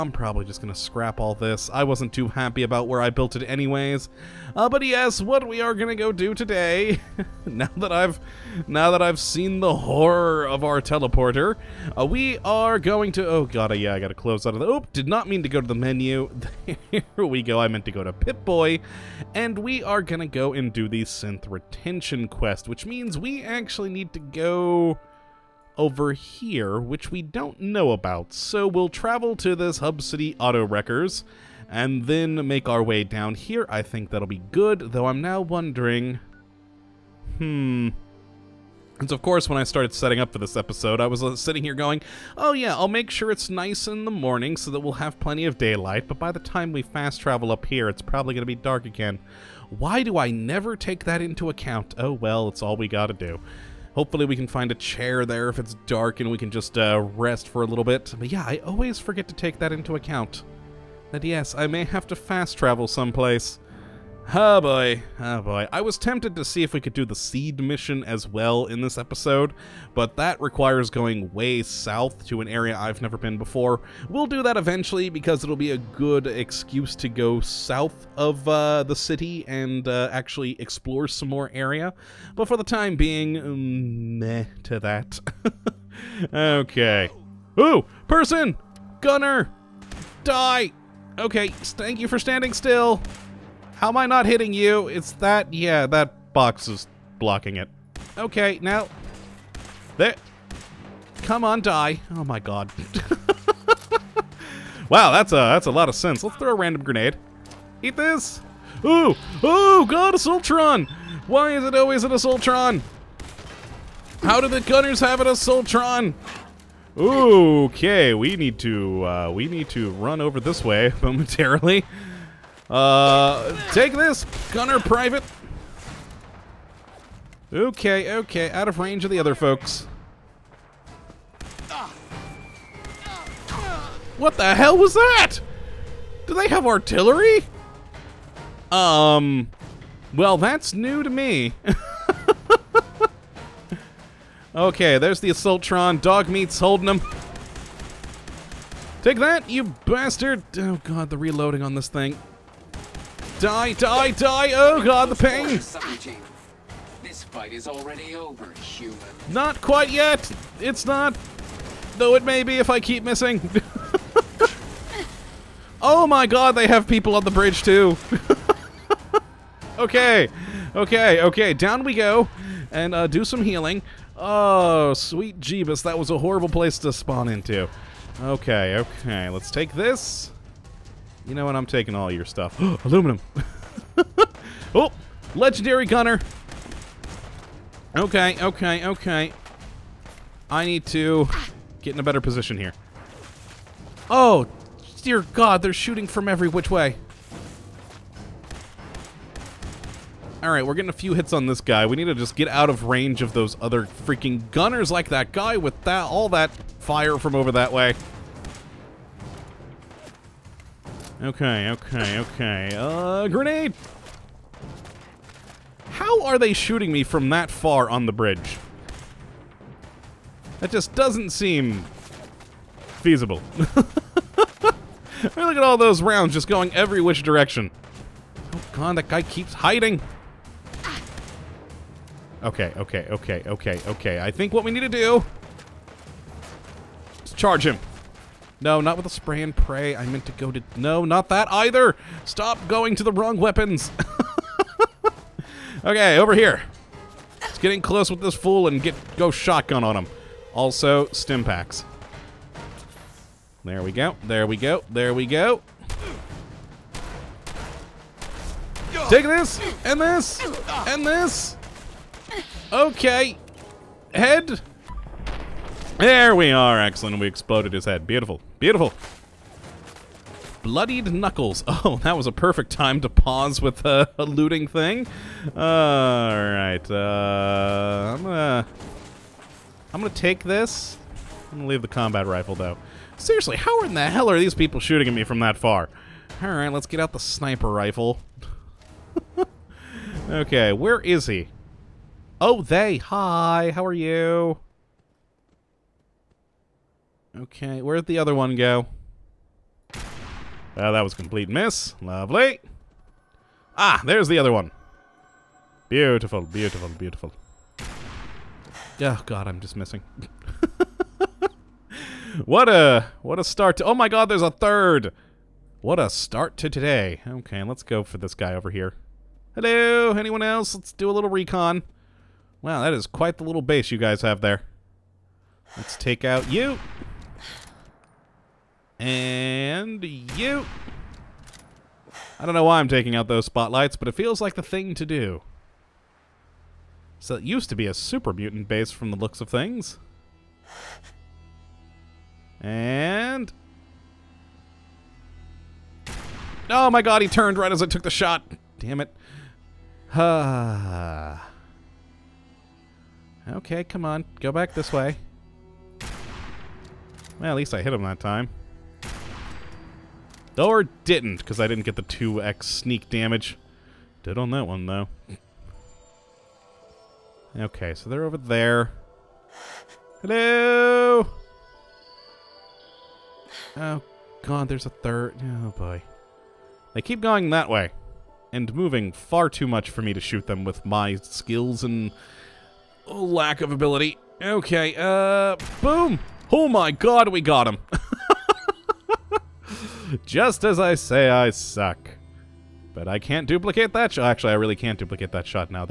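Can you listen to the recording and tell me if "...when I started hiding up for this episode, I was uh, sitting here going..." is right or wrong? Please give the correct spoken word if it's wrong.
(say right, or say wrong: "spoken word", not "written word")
wrong: "setting", not "hiding".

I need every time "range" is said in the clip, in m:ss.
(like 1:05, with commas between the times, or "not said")
2:08, 3:22.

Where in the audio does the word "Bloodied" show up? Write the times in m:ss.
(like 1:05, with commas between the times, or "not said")
4:30.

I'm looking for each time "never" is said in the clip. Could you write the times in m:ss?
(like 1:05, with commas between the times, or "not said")
0:50, 1:13.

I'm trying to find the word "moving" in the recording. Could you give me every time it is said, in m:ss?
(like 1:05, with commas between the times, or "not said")
6:18.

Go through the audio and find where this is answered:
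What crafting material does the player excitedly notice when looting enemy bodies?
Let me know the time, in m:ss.
3:02.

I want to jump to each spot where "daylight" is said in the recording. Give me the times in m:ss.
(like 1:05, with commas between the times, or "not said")
0:45.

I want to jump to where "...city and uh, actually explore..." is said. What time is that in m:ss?
1:18.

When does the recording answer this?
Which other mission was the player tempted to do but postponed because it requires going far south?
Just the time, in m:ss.
1:07.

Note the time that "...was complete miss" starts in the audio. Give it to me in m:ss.
5:01.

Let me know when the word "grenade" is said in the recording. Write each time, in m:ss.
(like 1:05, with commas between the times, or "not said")
1:46, 3:33.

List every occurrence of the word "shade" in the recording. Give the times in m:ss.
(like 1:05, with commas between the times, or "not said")
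not said.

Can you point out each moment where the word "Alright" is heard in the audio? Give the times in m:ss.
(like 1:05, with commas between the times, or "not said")
4:35, 4:46.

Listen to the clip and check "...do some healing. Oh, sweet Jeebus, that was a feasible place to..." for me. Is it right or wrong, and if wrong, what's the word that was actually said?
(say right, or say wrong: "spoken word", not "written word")
wrong: "horrible", not "feasible".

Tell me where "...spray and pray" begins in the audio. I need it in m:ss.
3:59.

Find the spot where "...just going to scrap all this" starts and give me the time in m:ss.
0:00.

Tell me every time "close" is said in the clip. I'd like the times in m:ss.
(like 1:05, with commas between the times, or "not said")
0:14, 4:07.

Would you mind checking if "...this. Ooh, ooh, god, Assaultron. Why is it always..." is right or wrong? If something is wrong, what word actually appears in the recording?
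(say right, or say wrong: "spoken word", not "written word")
right.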